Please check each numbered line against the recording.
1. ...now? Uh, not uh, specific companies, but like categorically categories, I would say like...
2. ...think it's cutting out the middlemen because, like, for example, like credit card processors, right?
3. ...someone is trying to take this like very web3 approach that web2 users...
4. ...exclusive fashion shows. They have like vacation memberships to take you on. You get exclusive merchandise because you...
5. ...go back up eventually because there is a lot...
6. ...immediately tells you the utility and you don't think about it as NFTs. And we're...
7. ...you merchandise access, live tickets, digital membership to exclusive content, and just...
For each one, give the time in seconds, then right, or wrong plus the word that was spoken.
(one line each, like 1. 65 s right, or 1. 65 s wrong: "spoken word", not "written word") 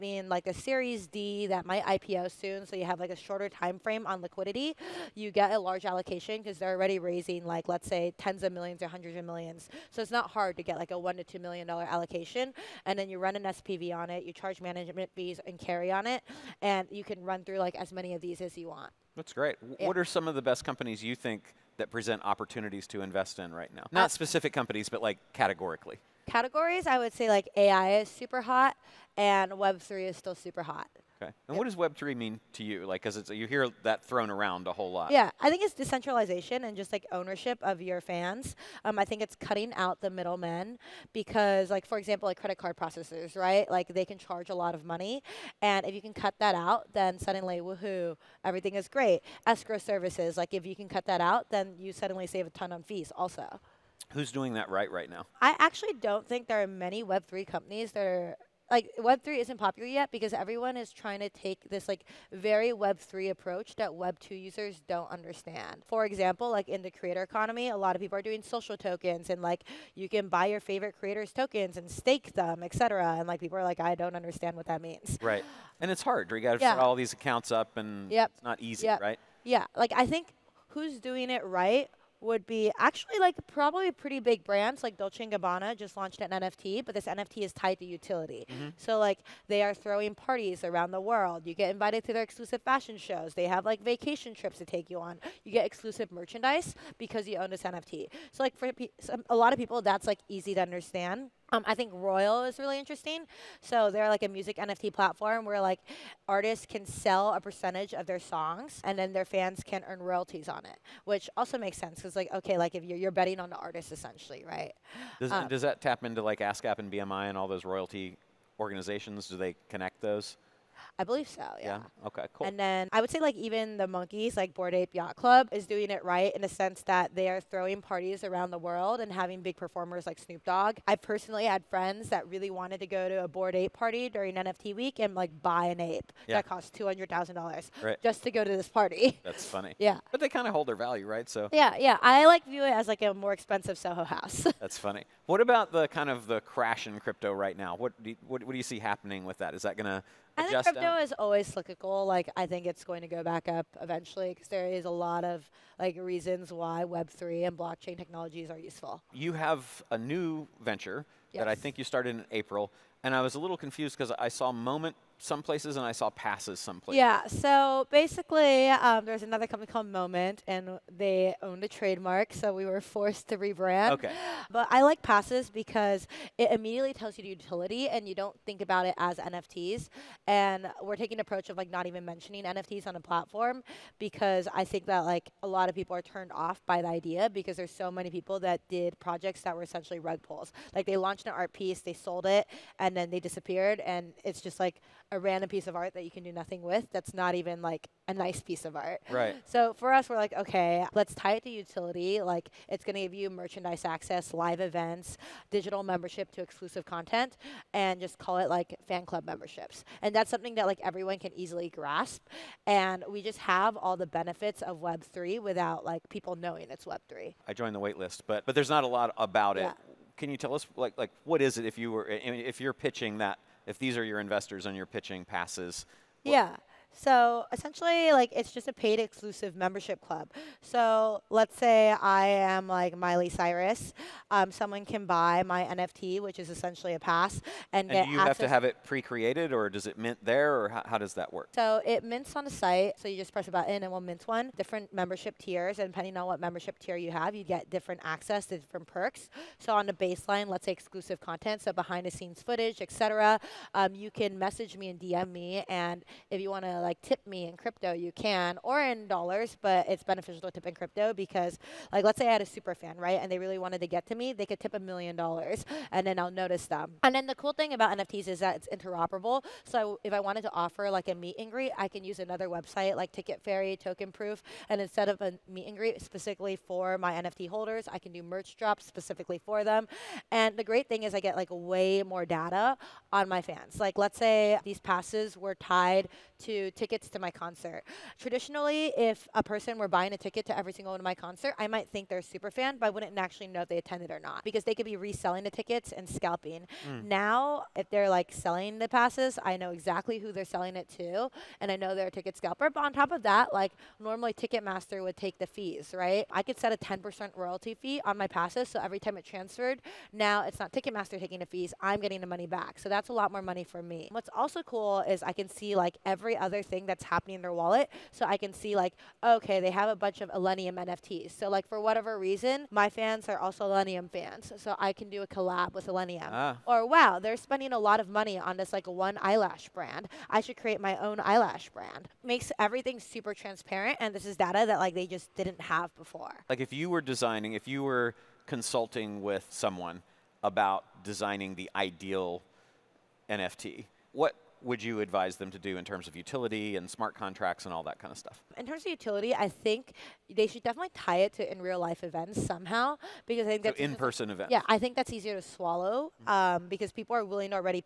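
1. 23 s right
2. 39 s right
3. 60 s wrong: "everyone", not "someone"
4. 92 s wrong: "trips", not "memberships"
5. 153 s right
6. 176 s right
7. 203 s wrong: "events", not "tickets".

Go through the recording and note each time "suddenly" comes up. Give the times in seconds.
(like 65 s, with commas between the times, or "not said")
47 s, 51 s.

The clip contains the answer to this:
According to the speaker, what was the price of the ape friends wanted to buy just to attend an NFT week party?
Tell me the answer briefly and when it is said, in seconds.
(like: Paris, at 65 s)
$200,000, at 136 s.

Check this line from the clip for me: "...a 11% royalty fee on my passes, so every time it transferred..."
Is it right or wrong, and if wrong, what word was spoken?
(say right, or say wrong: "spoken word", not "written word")
wrong: "10", not "11".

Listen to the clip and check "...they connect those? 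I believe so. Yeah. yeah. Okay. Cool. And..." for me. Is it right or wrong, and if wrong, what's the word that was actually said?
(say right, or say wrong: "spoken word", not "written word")
right.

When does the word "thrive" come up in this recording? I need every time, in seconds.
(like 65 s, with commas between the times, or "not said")
not said.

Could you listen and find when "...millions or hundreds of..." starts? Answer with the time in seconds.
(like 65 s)
8 s.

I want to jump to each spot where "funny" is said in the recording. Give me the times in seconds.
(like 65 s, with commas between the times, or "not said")
139 s, 144 s.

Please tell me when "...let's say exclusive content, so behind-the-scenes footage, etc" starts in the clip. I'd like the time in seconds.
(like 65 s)
250 s.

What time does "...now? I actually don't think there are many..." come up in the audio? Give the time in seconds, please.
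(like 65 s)
55 s.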